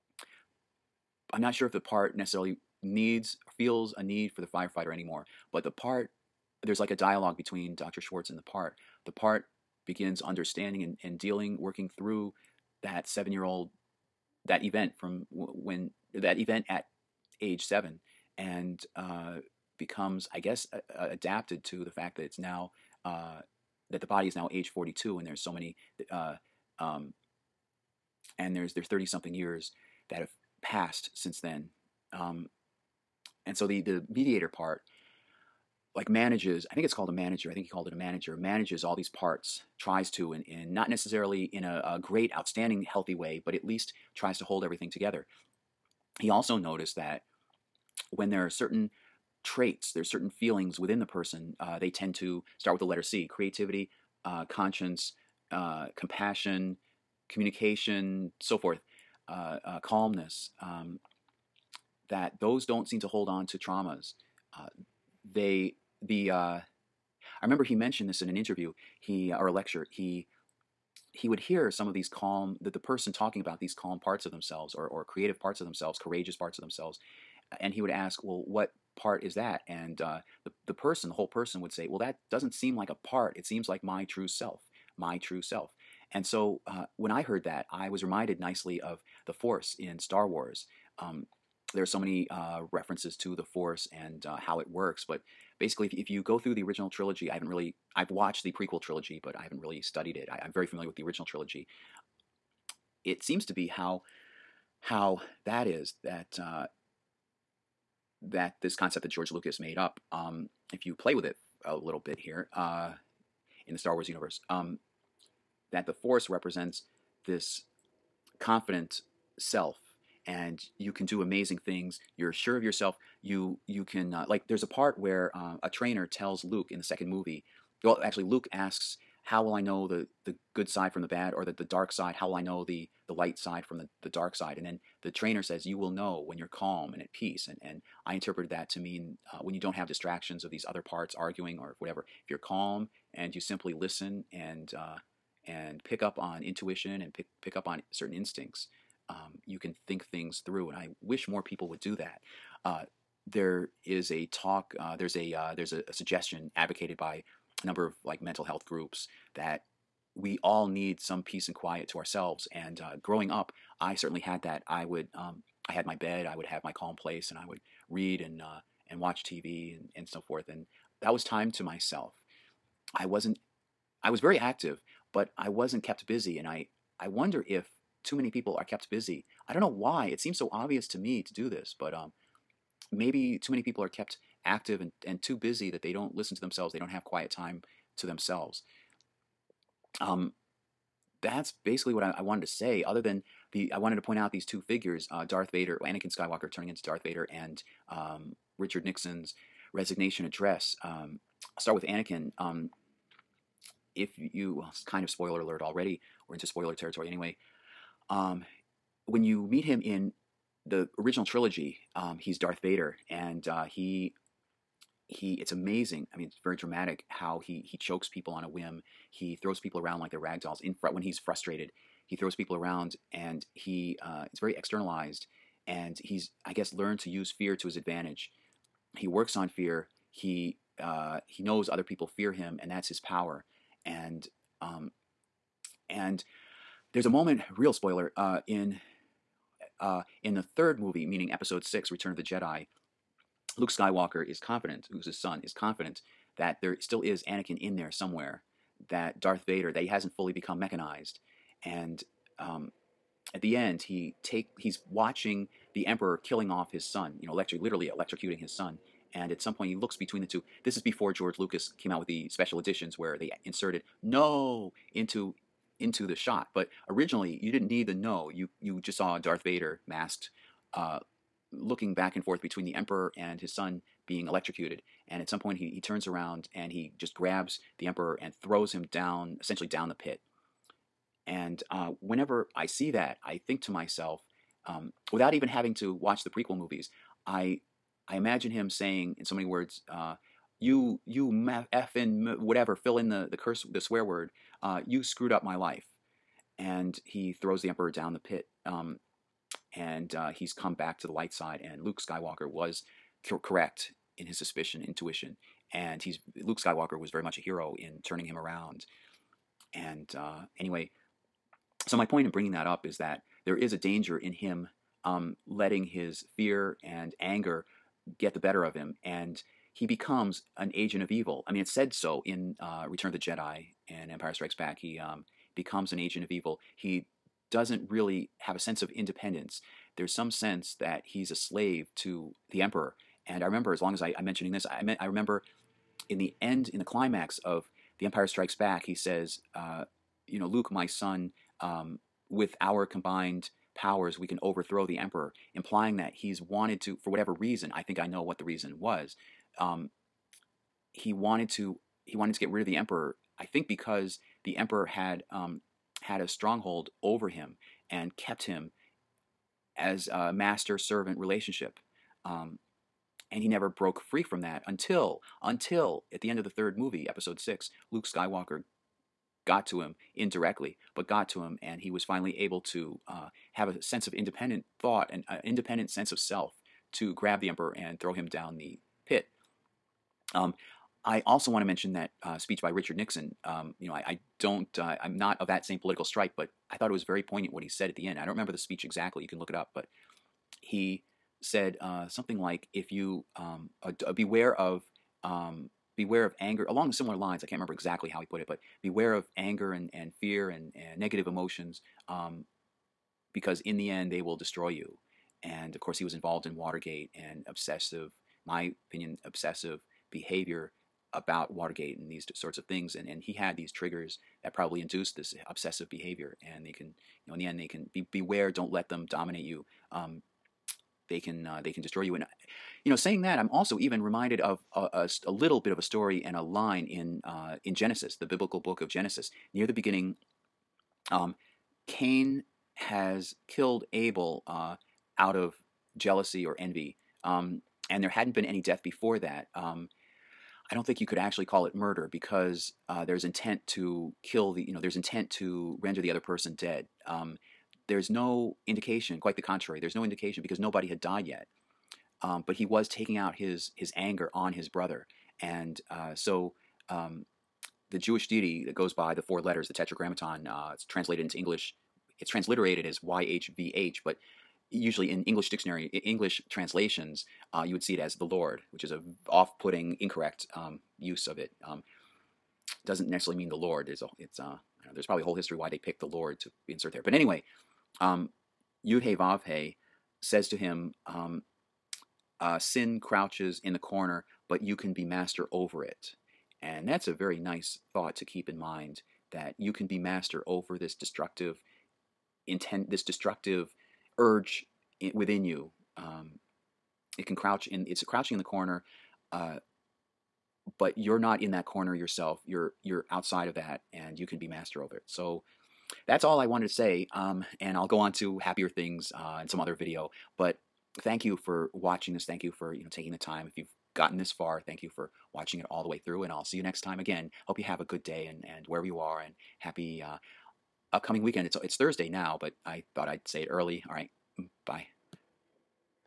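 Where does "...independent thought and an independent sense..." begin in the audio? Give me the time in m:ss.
6:14.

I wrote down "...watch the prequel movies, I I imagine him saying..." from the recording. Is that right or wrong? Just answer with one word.
right.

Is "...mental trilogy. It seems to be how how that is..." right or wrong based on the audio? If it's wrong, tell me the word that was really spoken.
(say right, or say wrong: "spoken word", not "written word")
wrong: "original", not "mental".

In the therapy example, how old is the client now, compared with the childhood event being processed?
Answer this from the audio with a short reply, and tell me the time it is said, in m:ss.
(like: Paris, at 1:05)
42, at 0:24.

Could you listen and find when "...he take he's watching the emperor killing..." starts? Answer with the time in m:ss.
4:13.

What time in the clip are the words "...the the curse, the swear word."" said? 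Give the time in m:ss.
4:53.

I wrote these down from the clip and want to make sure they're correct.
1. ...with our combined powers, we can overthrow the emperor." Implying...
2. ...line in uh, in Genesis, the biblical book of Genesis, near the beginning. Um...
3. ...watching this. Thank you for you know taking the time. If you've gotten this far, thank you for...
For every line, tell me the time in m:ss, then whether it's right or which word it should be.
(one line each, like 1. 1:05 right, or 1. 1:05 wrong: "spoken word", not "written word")
1. 5:42 right
2. 7:06 right
3. 8:31 right.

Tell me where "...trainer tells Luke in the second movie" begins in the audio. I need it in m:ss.
2:05.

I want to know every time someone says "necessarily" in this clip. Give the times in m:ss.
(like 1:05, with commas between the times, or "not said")
0:02, 0:40, 7:53.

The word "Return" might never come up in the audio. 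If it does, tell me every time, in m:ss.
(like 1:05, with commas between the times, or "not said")
4:01, 5:22.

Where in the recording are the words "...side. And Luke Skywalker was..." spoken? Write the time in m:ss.
5:01.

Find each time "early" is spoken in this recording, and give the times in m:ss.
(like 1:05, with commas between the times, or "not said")
8:43.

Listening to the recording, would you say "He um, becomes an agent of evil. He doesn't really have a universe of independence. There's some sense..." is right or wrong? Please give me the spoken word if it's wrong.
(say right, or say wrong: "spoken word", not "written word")
wrong: "sense", not "universe".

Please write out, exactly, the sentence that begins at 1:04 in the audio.
Uh, they, the, uh, I remember he mentioned this in an interview, he uh, or a lecture.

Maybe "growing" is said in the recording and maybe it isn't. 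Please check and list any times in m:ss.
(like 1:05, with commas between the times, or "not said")
2:43.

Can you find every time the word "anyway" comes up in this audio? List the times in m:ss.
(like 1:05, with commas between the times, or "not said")
3:27, 5:10, 7:57.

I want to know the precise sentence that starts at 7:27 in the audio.
Um, there's no indication, quite the contrary, there's no indication because nobody had died yet.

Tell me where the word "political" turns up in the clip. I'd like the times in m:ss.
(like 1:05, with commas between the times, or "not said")
6:25.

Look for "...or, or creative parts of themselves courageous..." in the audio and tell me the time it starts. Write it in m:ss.
1:14.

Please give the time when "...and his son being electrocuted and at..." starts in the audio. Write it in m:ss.
4:33.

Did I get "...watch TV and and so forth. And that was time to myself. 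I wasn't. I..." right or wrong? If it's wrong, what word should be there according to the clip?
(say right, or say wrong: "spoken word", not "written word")
right.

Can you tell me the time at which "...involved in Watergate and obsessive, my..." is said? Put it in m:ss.
6:46.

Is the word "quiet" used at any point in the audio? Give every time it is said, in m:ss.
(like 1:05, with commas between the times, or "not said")
2:41, 3:07.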